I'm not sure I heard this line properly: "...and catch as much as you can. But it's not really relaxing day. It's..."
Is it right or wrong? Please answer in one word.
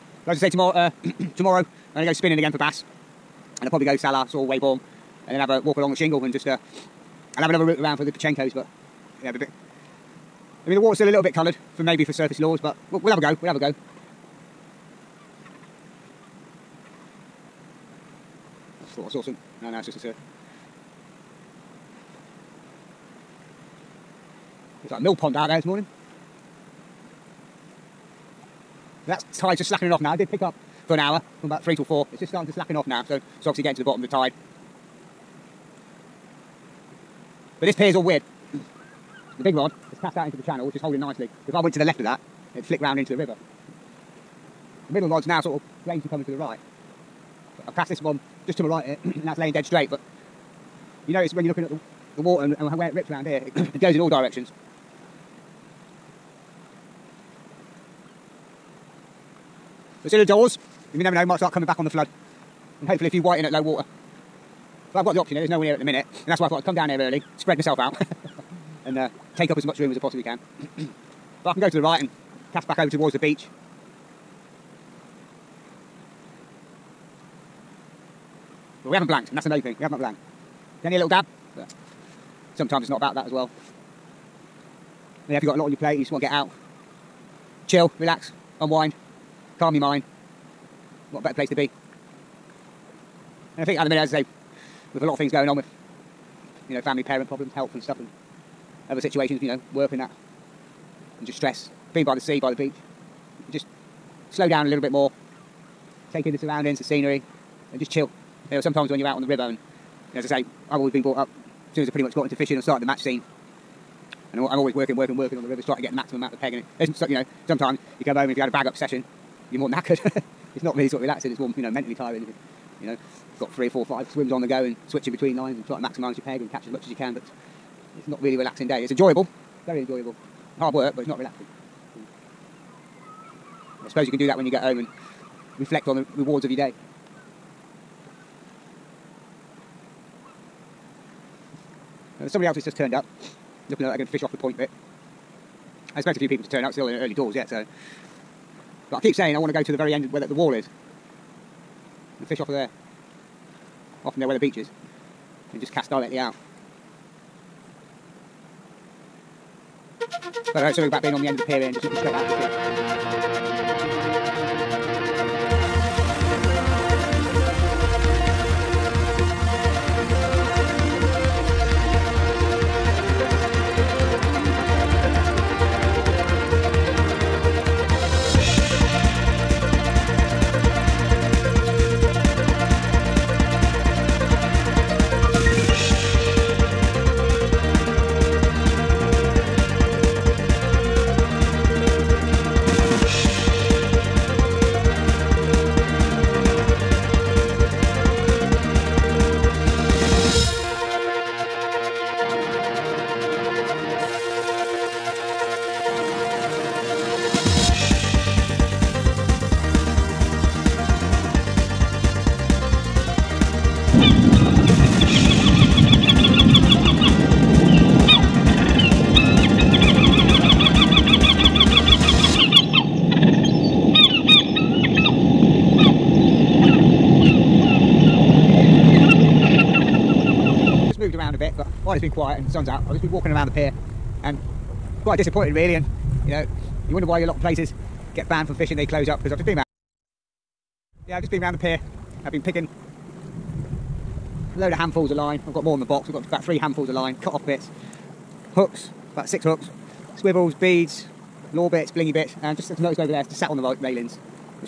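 right.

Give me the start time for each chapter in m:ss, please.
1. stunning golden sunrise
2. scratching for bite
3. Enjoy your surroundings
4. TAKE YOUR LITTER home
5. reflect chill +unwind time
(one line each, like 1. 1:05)
1. 1:40
2. 0:36
3. 2:12
4. 3:48
5. 1:08.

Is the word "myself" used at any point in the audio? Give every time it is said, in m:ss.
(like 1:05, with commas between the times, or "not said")
1:07.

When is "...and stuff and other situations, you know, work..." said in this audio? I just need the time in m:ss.
1:37.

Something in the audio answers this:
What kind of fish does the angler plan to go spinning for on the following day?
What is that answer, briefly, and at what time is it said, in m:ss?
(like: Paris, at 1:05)
Bass, at 0:02.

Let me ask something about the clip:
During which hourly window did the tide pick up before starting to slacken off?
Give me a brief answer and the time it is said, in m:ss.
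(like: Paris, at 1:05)
From about 3 till 4, at 0:31.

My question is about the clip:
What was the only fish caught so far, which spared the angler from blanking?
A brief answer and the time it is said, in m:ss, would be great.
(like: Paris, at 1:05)
A little dab, at 1:20.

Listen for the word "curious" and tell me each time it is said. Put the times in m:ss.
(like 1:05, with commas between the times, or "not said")
not said.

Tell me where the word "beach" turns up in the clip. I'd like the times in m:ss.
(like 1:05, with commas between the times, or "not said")
1:13, 1:42, 2:34.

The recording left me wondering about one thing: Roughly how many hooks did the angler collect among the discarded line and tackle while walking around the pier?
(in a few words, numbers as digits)
About 6.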